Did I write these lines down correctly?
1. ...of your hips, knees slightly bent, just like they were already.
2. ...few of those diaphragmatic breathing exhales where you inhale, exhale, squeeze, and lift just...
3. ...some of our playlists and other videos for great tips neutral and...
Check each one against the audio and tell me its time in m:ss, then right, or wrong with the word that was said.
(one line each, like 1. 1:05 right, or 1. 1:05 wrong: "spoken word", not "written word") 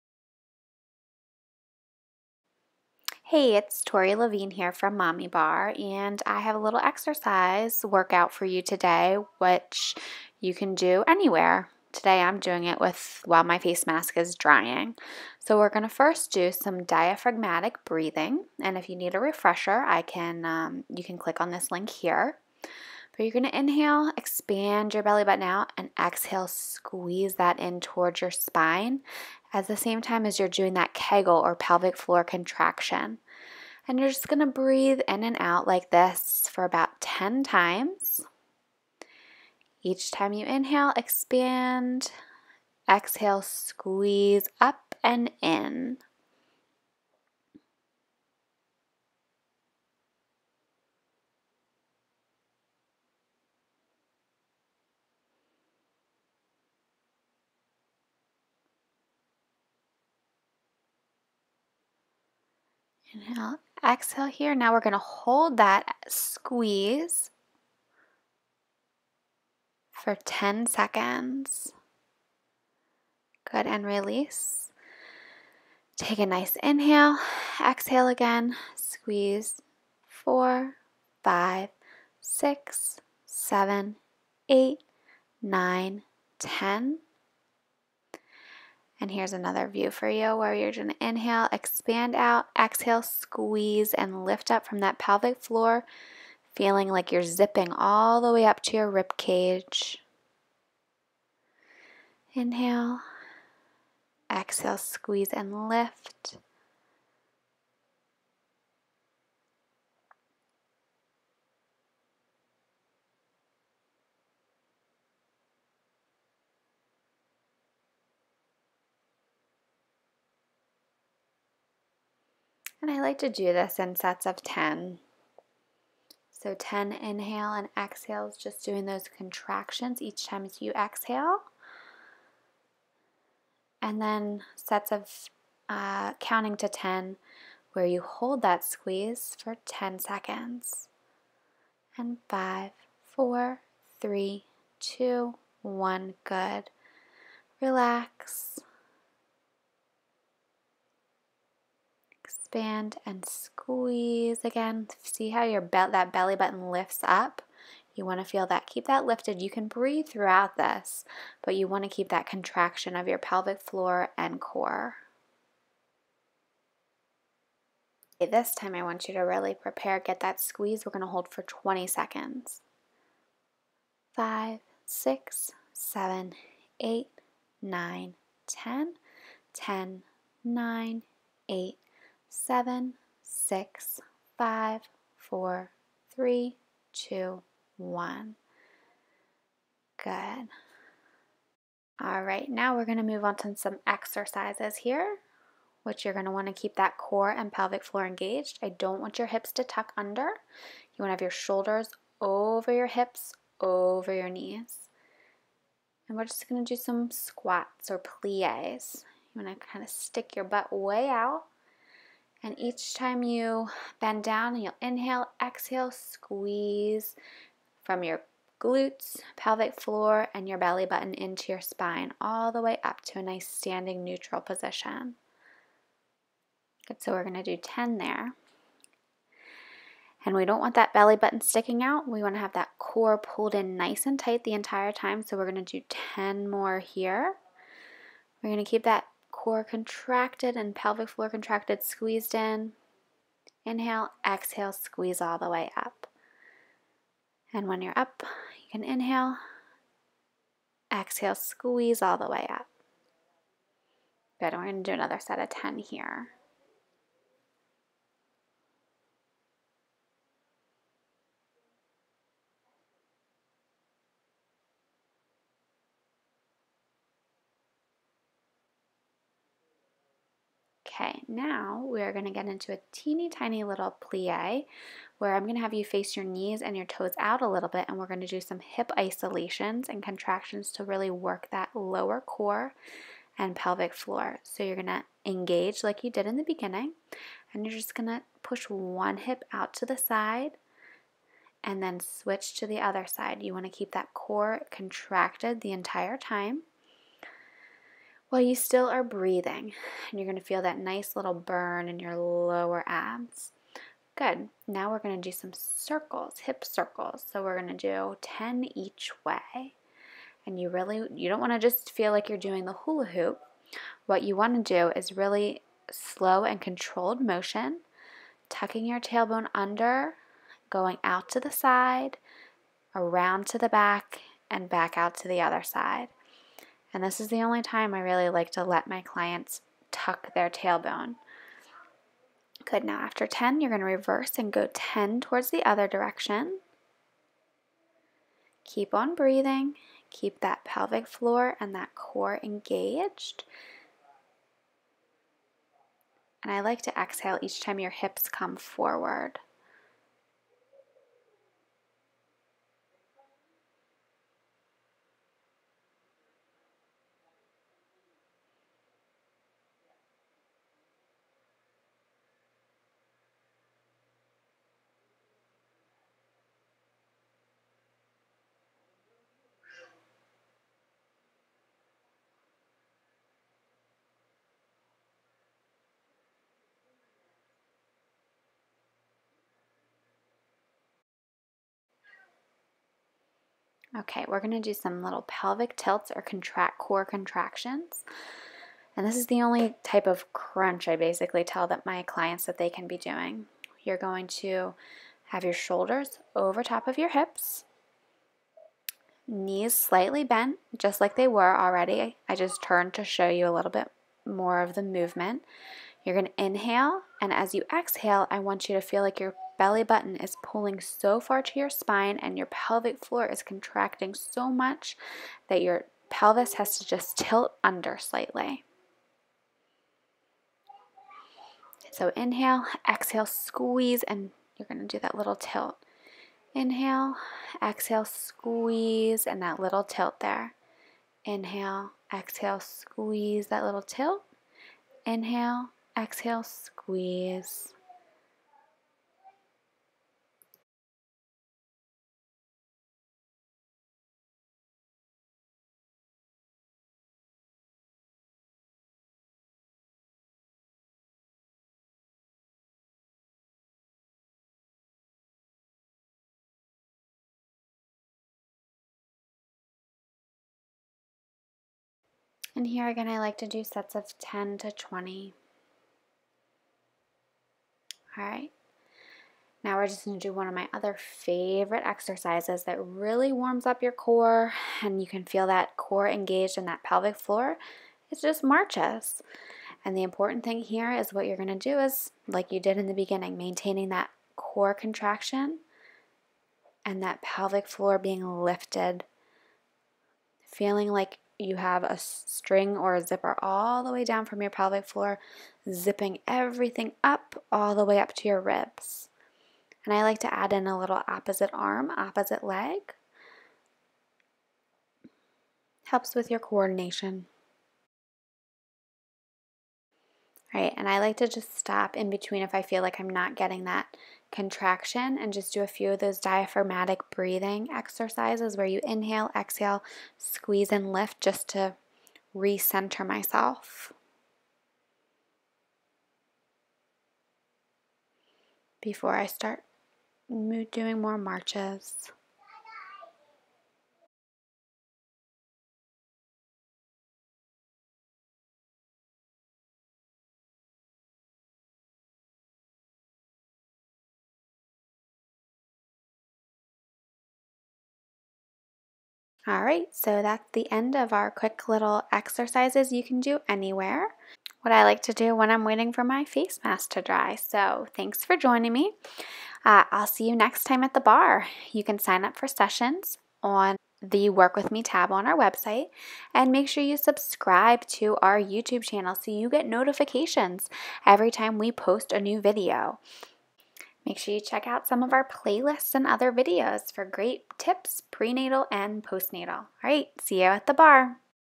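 1. 6:36 right
2. 8:35 wrong: "exercises", not "exhales"
3. 9:34 wrong: "prenatal", not "neutral".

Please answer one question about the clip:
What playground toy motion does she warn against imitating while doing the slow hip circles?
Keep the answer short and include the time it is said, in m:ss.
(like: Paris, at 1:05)
Hula hoop, at 5:12.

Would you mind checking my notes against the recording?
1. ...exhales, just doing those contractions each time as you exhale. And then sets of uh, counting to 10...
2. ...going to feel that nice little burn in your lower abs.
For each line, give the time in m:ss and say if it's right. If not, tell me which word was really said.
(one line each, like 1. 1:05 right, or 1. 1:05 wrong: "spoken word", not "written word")
1. 2:07 right
2. 5:00 right.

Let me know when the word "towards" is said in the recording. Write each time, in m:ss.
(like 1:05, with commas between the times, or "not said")
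0:27, 5:35.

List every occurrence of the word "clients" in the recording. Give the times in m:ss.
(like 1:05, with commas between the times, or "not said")
5:29, 6:32.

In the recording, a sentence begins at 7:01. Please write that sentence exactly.
So inhale, exhale, squeeze, and you're going to do that little tilt.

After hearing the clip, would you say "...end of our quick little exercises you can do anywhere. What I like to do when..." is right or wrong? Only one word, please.
right.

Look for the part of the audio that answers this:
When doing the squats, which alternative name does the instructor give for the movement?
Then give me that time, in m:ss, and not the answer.
3:27.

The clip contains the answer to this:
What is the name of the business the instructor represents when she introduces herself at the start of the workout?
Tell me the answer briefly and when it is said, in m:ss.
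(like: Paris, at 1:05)
Mommy Barre, at 0:04.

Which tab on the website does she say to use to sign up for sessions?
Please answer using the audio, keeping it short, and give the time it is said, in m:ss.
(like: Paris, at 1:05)
Work With Me, at 9:24.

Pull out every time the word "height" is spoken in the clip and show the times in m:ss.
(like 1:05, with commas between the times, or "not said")
not said.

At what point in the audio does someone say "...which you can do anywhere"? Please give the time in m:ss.
0:09.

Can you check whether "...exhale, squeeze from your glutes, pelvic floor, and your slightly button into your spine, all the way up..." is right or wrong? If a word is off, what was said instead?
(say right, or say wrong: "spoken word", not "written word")
wrong: "belly", not "slightly".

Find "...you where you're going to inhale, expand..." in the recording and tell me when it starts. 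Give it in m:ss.
1:30.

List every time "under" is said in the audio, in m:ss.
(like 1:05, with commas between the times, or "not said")
3:19, 5:19, 6:57.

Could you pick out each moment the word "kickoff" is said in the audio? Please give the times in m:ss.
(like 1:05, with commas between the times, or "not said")
not said.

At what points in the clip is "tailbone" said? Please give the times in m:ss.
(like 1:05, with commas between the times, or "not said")
5:19, 5:30.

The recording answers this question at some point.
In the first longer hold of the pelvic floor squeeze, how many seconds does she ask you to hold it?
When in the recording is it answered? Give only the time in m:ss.
2:51.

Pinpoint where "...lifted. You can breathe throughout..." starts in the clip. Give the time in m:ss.
2:39.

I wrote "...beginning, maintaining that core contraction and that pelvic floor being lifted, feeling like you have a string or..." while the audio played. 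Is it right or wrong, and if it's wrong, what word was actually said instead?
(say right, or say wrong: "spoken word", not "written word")
right.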